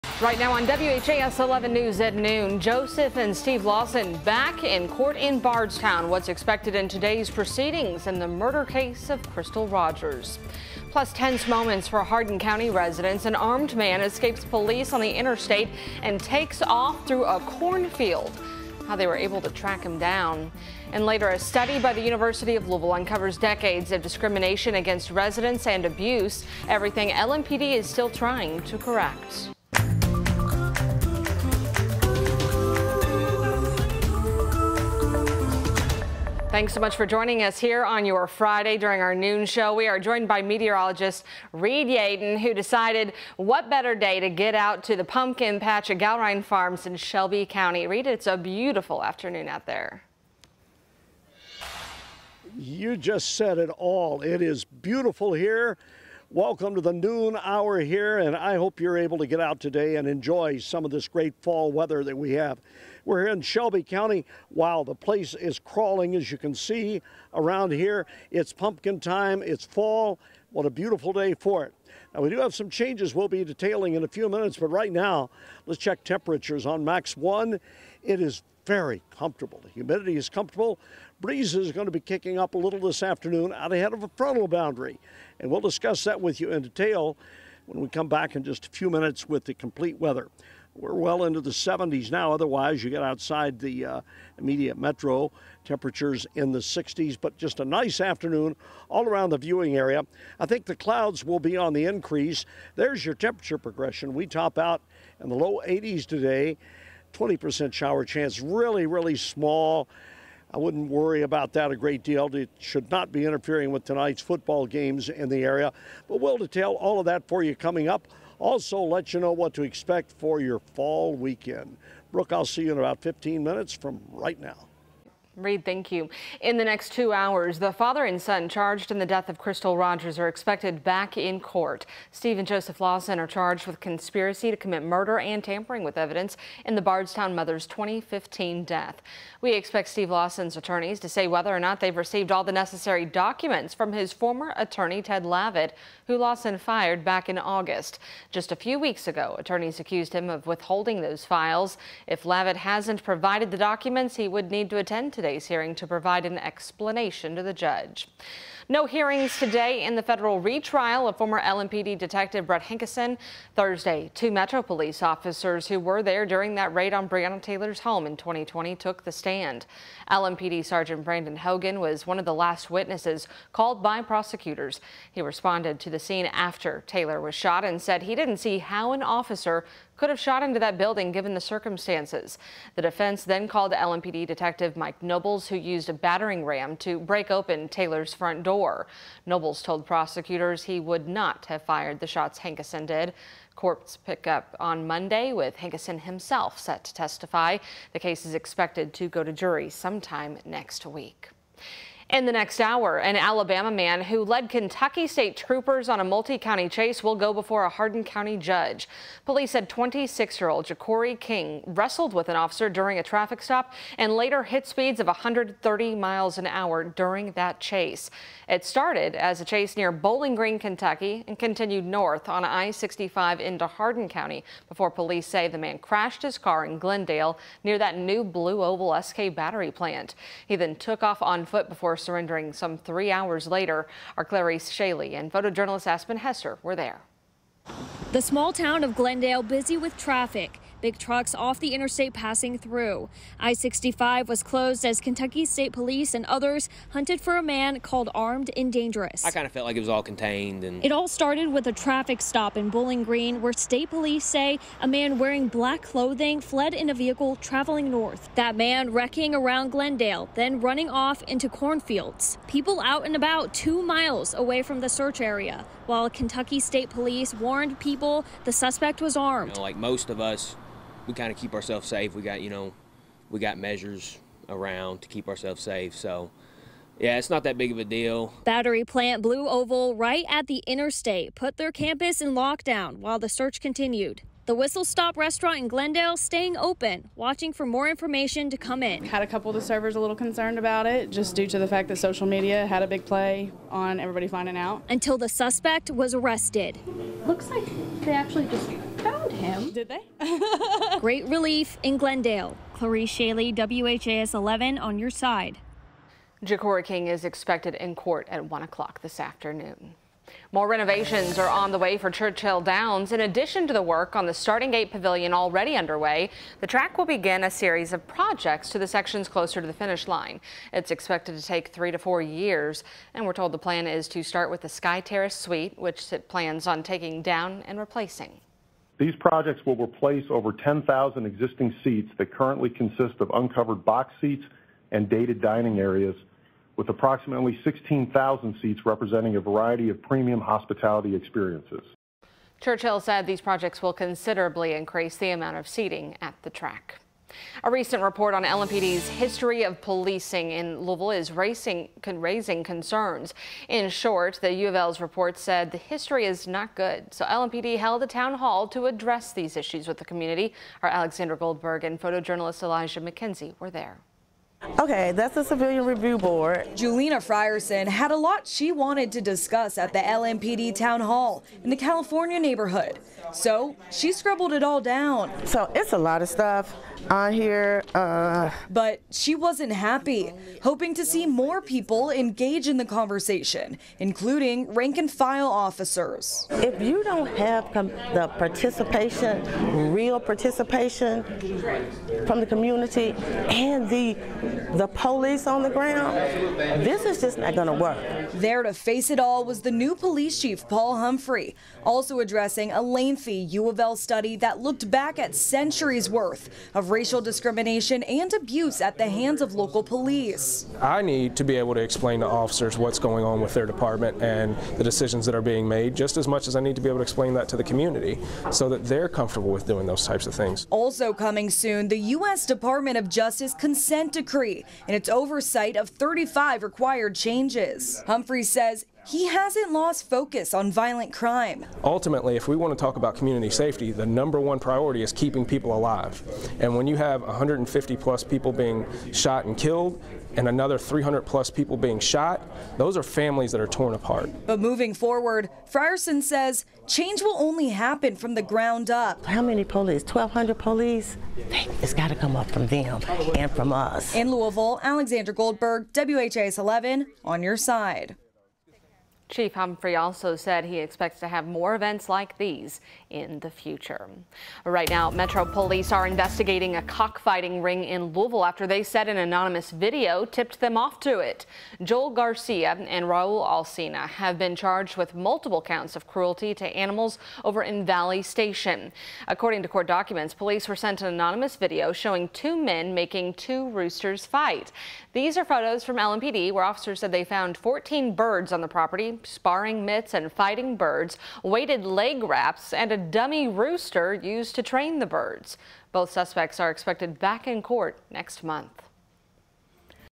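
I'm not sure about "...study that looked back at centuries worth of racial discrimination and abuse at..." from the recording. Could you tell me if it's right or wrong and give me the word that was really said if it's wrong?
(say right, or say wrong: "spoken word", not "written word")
right.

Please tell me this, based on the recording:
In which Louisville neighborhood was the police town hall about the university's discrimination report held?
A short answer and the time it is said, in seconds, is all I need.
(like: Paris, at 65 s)
California neighborhood, at 371 s.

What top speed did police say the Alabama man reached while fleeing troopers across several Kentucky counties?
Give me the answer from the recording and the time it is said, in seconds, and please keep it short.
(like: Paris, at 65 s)
130 miles an hour, at 215 s.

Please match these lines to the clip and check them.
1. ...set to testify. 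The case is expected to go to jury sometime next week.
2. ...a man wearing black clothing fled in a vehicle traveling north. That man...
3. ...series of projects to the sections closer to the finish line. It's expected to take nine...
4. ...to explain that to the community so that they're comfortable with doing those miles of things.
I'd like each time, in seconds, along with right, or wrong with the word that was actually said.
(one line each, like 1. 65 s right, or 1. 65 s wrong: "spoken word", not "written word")
1. 196 s right
2. 254 s right
3. 317 s wrong: "three", not "nine"
4. 416 s wrong: "types", not "miles".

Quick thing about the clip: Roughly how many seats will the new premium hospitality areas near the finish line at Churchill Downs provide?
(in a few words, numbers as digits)
16,000.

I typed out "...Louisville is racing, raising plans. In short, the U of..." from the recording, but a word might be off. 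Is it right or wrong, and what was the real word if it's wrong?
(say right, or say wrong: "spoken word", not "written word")
wrong: "concerns", not "plans".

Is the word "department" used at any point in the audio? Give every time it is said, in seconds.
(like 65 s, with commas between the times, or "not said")
413 s, 422 s.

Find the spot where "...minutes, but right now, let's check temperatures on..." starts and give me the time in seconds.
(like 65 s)
74 s.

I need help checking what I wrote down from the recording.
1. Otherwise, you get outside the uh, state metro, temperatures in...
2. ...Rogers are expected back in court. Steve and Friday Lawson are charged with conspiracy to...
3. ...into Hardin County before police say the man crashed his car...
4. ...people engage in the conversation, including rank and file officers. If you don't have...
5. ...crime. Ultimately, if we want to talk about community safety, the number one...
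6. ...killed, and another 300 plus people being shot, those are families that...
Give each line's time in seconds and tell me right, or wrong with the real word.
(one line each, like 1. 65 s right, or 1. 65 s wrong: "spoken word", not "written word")
1. 92 s wrong: "immediate", not "state"
2. 129 s wrong: "Joseph", not "Friday"
3. 223 s right
4. 381 s right
5. 431 s right
6. 439 s right.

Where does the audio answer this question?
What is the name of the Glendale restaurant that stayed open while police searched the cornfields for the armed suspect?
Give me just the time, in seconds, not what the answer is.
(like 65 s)
284 s.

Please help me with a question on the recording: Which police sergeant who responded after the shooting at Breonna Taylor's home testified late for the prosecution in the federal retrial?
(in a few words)
Brandon Hogan.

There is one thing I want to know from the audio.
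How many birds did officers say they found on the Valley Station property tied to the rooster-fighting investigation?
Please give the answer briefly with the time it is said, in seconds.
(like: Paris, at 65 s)
14, at 487 s.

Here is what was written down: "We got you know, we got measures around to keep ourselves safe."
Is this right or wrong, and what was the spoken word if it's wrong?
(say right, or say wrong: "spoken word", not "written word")
right.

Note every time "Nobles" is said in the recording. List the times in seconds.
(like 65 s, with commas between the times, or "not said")
185 s, 189 s.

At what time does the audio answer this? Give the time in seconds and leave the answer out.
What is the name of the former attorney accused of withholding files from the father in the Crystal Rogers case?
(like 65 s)
145 s.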